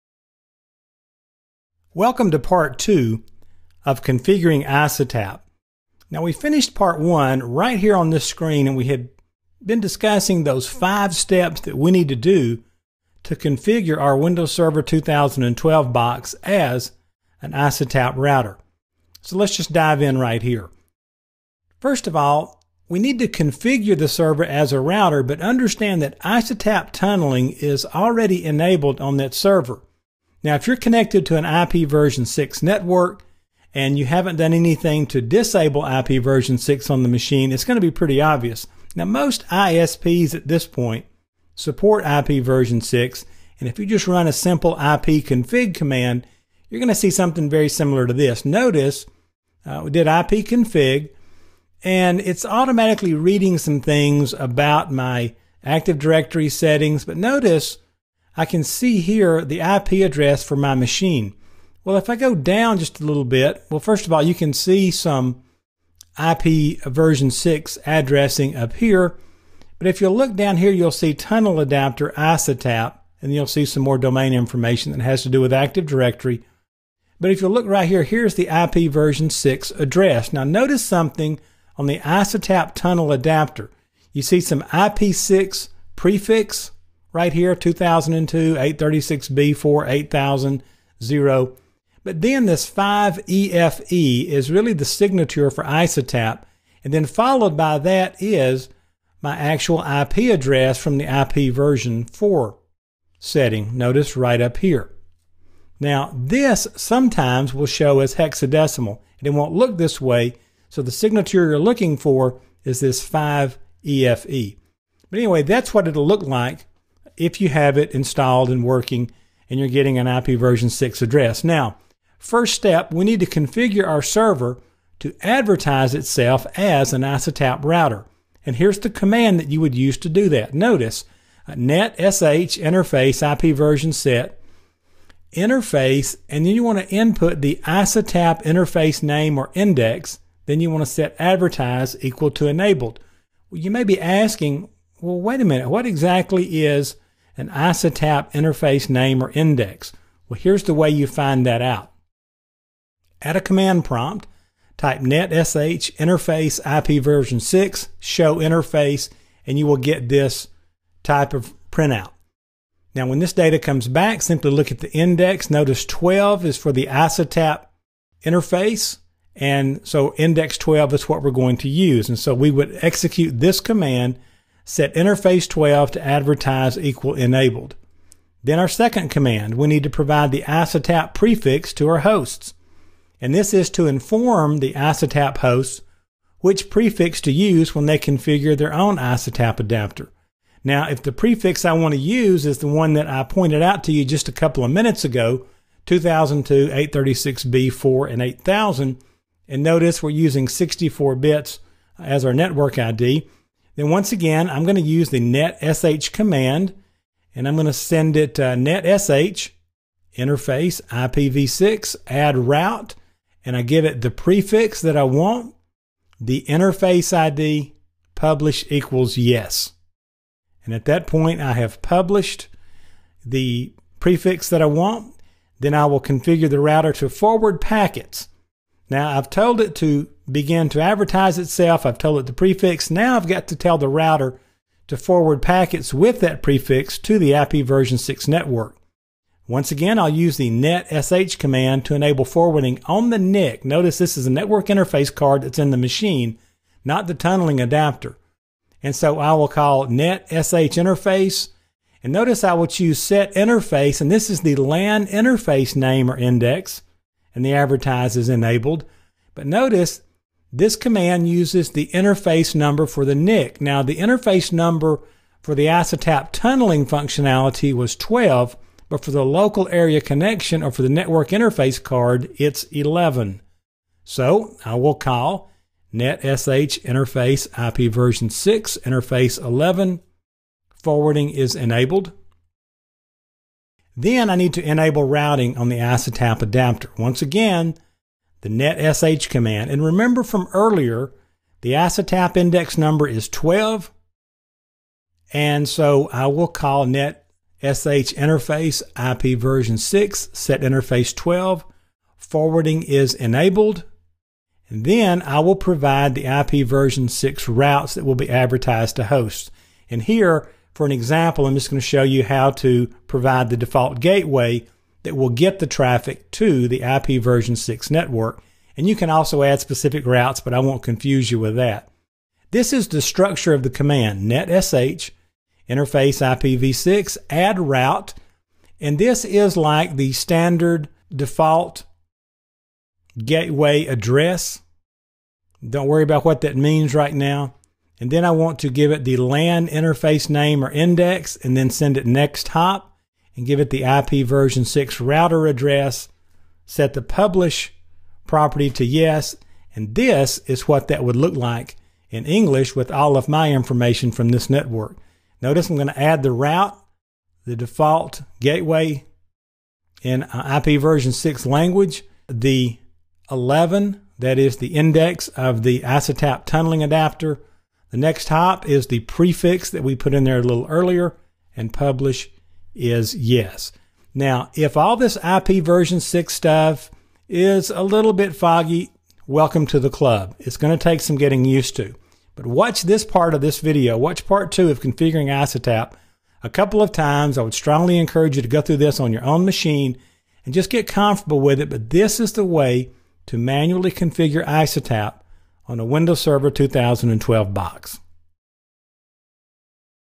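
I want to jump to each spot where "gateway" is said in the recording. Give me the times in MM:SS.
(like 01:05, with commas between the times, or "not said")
05:13, 05:33, 05:58.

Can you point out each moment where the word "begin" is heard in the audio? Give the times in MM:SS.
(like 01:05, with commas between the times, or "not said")
03:50.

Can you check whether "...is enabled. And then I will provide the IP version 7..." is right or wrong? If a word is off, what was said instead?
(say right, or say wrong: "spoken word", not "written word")
wrong: "6", not "7".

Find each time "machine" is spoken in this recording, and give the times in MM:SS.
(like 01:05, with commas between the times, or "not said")
00:37, 01:00, 04:05, 06:29.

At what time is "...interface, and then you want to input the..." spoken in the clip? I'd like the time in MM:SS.
02:15.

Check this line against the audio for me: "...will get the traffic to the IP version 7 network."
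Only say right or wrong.
wrong.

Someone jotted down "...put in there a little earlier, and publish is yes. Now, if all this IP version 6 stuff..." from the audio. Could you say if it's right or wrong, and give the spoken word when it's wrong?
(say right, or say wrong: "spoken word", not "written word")
right.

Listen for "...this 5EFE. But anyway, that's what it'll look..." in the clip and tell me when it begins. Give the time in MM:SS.
01:52.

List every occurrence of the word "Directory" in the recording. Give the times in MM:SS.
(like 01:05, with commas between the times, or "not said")
00:55, 01:15.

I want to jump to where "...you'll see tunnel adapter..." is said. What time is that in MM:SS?
01:10.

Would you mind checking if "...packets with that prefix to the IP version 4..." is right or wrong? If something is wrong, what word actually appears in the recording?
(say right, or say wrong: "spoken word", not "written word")
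wrong: "6", not "4".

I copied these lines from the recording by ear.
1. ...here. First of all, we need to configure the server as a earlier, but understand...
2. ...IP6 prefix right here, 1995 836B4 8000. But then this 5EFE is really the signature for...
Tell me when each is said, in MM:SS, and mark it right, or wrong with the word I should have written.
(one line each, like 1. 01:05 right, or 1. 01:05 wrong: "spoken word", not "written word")
1. 00:20 wrong: "router", not "earlier"
2. 01:24 wrong: "2002", not "1995".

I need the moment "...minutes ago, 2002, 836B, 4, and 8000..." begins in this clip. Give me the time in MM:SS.
03:14.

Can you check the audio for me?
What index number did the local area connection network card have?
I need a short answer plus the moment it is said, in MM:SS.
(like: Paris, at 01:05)
11, at 04:32.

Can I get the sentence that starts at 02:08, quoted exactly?
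And here's the command that you would use to do that.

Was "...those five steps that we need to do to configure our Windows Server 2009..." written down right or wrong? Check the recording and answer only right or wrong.
wrong.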